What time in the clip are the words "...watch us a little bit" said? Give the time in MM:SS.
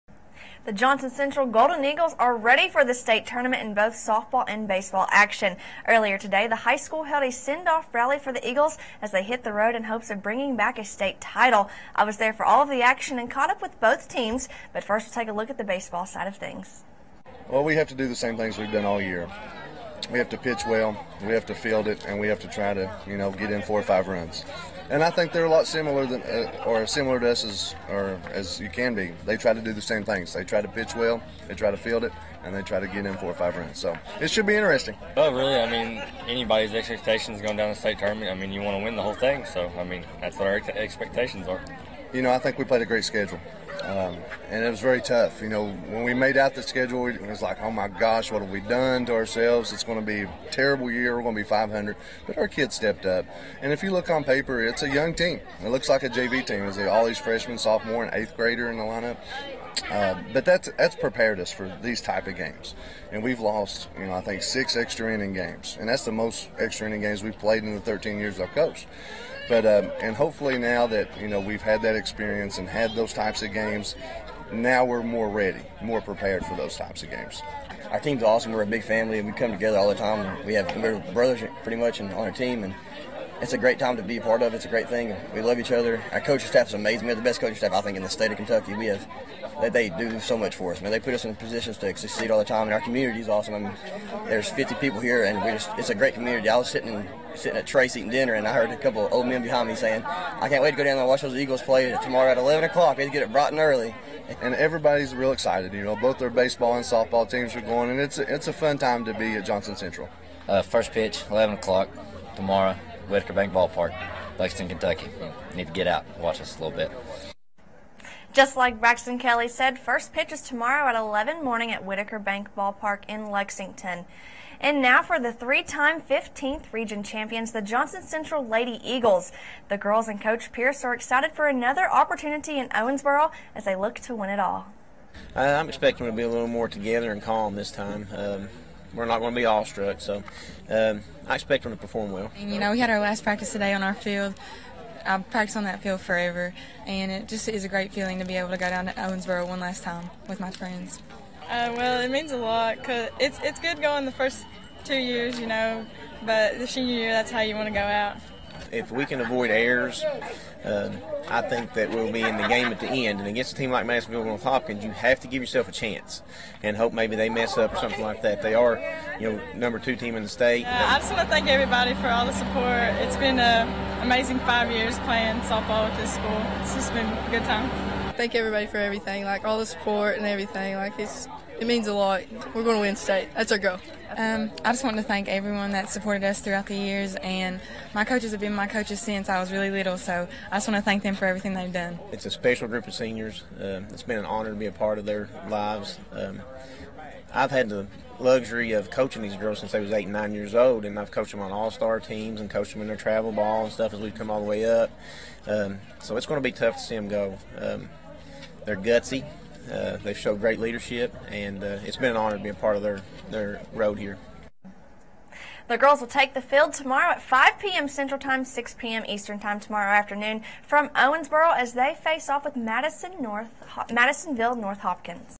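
01:56.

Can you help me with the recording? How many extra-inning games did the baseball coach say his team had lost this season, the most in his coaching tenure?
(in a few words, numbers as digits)
6.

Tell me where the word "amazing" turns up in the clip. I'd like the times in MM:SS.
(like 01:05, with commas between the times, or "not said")
01:26, 02:54.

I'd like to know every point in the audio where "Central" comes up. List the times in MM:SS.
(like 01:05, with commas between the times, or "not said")
00:01, 01:49, 02:08, 03:37.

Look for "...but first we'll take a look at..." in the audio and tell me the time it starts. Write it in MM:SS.
00:14.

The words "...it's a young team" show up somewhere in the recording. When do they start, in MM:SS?
00:54.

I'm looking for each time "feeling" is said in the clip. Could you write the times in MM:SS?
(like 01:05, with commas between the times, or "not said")
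02:27.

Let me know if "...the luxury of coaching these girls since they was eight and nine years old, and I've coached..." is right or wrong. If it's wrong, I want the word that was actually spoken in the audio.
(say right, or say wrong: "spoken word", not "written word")
right.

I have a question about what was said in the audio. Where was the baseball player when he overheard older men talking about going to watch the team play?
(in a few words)
Trace.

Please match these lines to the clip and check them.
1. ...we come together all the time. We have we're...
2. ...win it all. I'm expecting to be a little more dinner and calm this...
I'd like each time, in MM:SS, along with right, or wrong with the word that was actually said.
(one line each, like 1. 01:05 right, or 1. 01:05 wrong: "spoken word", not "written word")
1. 01:19 right
2. 02:14 wrong: "together", not "dinner".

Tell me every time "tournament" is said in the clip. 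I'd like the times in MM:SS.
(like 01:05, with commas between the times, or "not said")
00:03, 00:37.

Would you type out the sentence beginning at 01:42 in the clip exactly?
They get it bright and early." And everybody's real excited.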